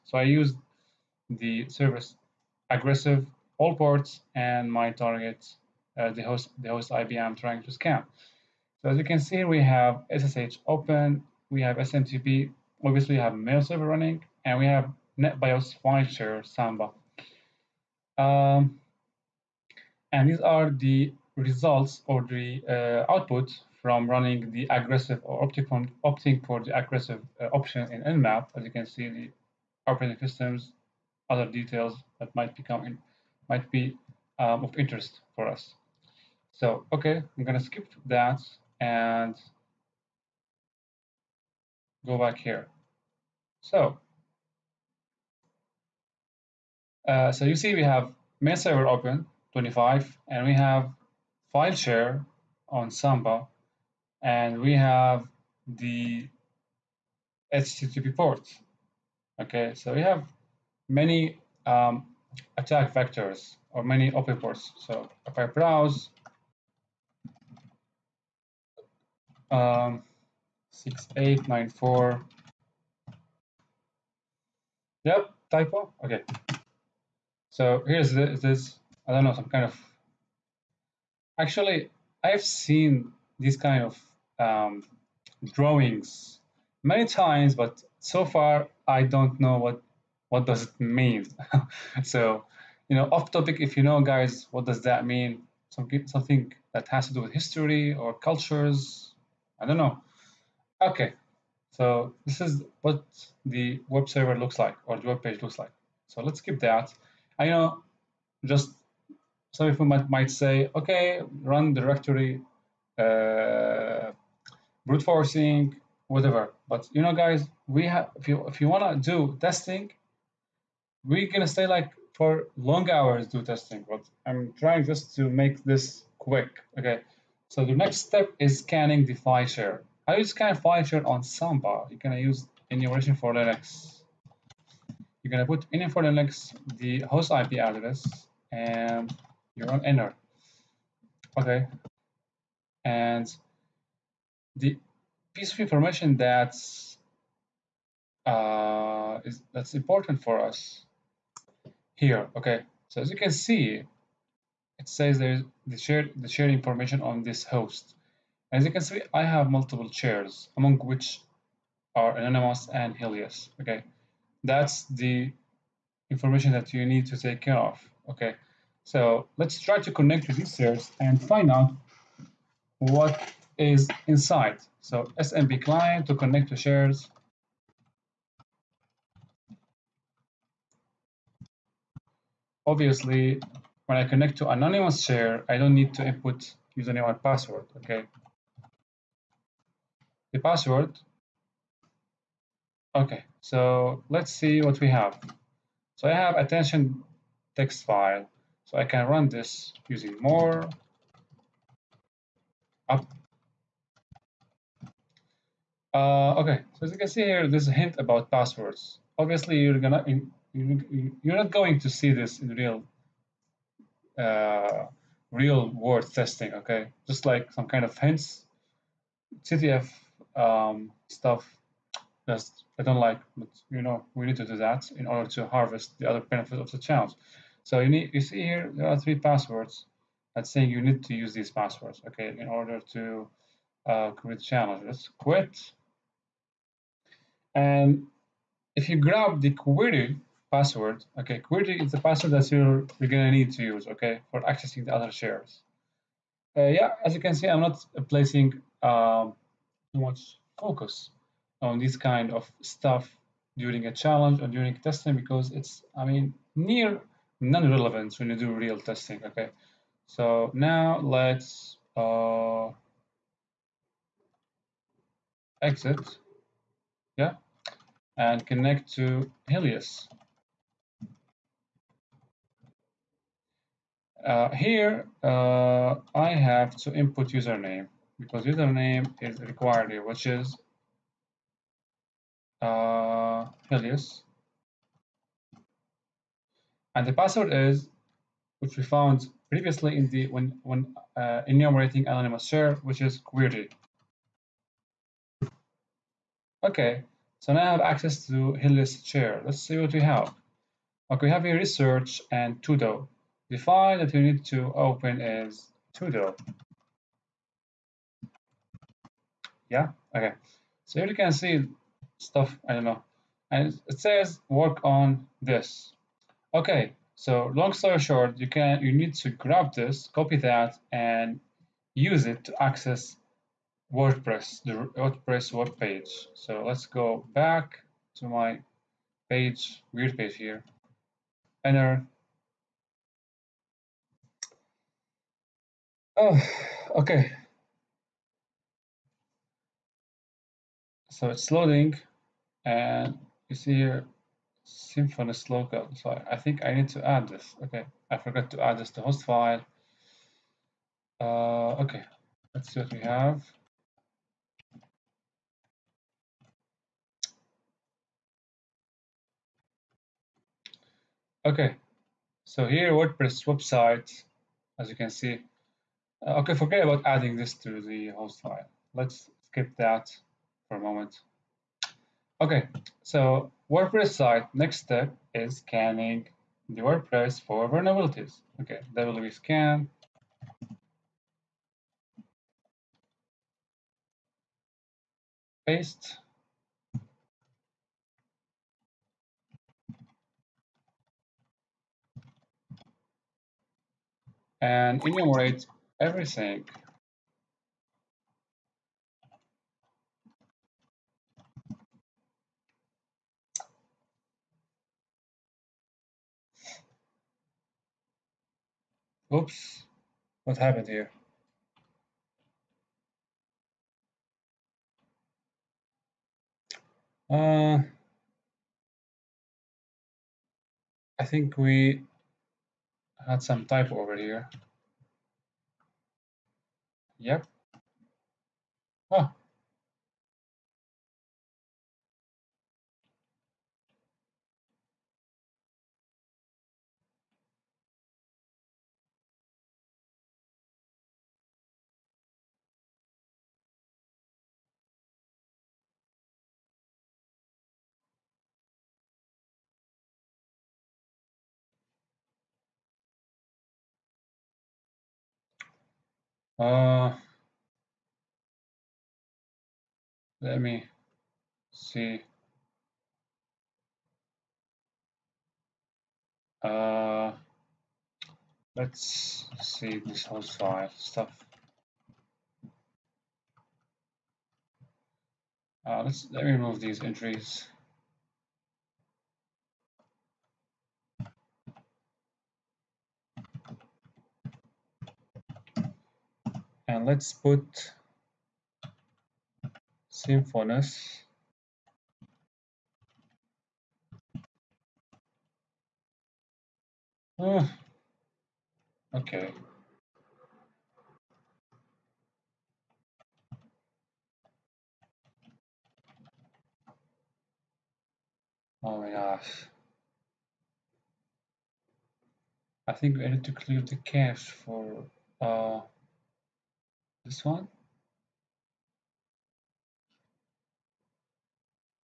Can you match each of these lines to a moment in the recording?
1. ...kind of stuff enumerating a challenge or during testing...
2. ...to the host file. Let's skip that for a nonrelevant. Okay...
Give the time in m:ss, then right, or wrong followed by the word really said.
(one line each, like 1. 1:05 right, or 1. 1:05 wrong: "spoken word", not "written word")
1. 4:11 wrong: "during", not "enumerating"
2. 6:07 wrong: "moment", not "nonrelevant".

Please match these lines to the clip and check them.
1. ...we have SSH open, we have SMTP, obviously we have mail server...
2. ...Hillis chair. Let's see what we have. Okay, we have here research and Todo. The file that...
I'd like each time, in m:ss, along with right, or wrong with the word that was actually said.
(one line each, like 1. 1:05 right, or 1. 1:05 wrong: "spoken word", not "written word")
1. 0:09 right
2. 4:58 right.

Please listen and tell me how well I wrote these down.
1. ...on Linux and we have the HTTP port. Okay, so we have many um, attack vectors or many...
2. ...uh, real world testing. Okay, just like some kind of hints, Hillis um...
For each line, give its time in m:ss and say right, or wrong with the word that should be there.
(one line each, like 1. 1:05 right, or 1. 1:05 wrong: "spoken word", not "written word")
1. 0:52 wrong: "Samba", not "Linux"
2. 3:34 wrong: "CTF", not "Hillis".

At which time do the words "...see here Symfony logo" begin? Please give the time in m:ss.
5:43.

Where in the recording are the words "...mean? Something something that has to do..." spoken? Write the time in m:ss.
1:35.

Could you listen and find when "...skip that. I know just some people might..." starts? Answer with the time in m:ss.
1:46.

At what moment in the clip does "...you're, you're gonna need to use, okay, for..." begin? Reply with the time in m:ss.
4:02.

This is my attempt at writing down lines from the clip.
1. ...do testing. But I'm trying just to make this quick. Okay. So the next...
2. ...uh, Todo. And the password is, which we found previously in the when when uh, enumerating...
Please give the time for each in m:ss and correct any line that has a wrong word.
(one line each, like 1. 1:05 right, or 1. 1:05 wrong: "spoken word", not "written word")
1. 2:03 right
2. 4:42 wrong: "Helios", not "Todo".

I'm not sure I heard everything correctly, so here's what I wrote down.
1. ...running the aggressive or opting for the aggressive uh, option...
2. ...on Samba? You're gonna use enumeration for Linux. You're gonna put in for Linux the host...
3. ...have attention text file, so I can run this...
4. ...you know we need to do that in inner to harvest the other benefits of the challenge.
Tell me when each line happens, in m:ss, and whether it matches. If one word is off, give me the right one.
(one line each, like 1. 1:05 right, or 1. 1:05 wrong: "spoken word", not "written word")
1. 0:24 right
2. 2:11 right
3. 3:16 right
4. 3:43 wrong: "order", not "inner".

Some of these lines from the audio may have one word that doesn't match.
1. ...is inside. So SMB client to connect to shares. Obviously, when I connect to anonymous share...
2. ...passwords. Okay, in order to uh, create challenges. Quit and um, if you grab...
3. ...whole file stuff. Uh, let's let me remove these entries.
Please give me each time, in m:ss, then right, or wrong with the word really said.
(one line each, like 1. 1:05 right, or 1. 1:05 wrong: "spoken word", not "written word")
1. 2:53 right
2. 3:51 right
3. 7:50 right.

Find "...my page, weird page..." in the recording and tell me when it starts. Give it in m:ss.
5:28.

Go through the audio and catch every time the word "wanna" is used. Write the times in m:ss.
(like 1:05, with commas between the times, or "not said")
1:58.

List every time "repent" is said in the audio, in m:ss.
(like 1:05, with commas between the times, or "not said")
not said.